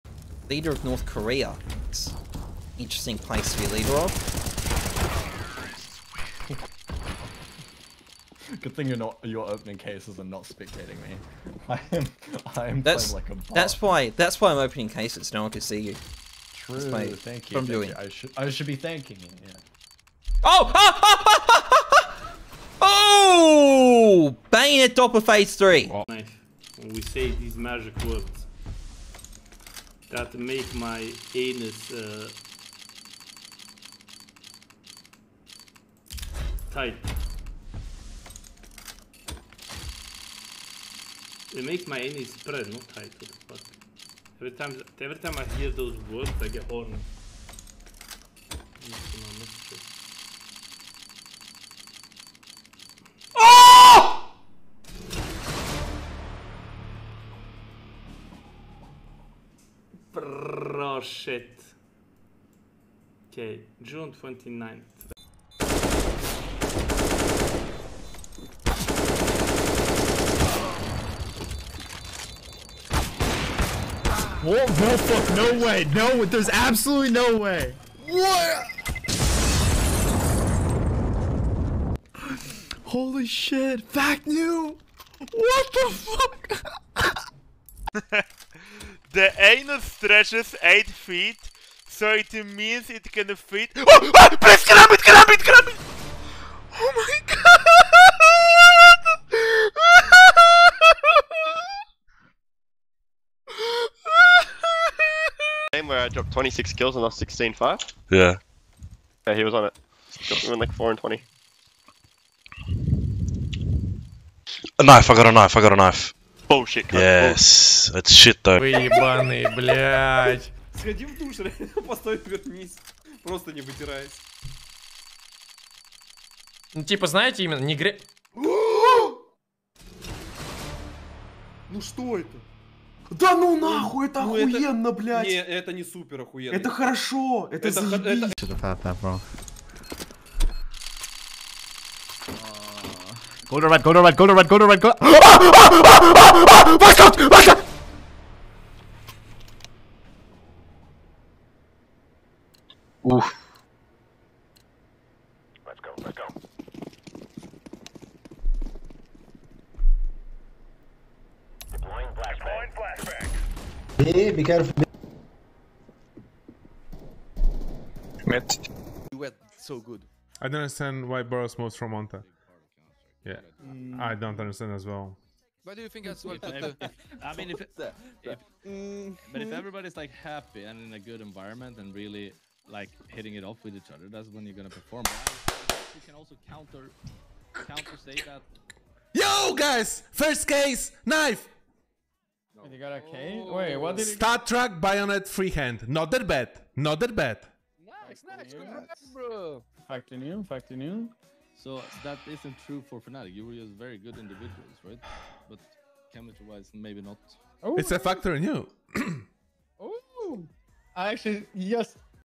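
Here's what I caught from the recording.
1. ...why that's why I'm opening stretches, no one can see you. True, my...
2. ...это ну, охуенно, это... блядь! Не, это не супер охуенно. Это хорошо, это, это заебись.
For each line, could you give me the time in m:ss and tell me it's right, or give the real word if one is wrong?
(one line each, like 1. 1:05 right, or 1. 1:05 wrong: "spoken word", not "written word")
1. 0:13 wrong: "cases", not "stretches"
2. 2:14 right.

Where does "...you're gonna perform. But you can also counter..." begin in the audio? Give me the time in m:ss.
3:04.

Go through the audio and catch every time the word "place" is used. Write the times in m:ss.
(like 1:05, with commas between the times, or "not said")
0:03.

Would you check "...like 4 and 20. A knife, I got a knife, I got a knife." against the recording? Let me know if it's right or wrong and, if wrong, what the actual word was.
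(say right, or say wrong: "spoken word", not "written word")
right.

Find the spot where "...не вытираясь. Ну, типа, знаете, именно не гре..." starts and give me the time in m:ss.
2:03.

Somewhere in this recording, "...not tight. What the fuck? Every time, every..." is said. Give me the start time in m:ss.
0:42.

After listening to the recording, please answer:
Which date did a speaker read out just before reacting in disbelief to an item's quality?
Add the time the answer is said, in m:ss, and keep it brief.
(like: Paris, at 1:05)
June 29th, at 1:03.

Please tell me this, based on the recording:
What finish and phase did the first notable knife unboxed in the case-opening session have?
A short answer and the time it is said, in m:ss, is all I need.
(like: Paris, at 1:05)
Doppler Phase 3, at 0:24.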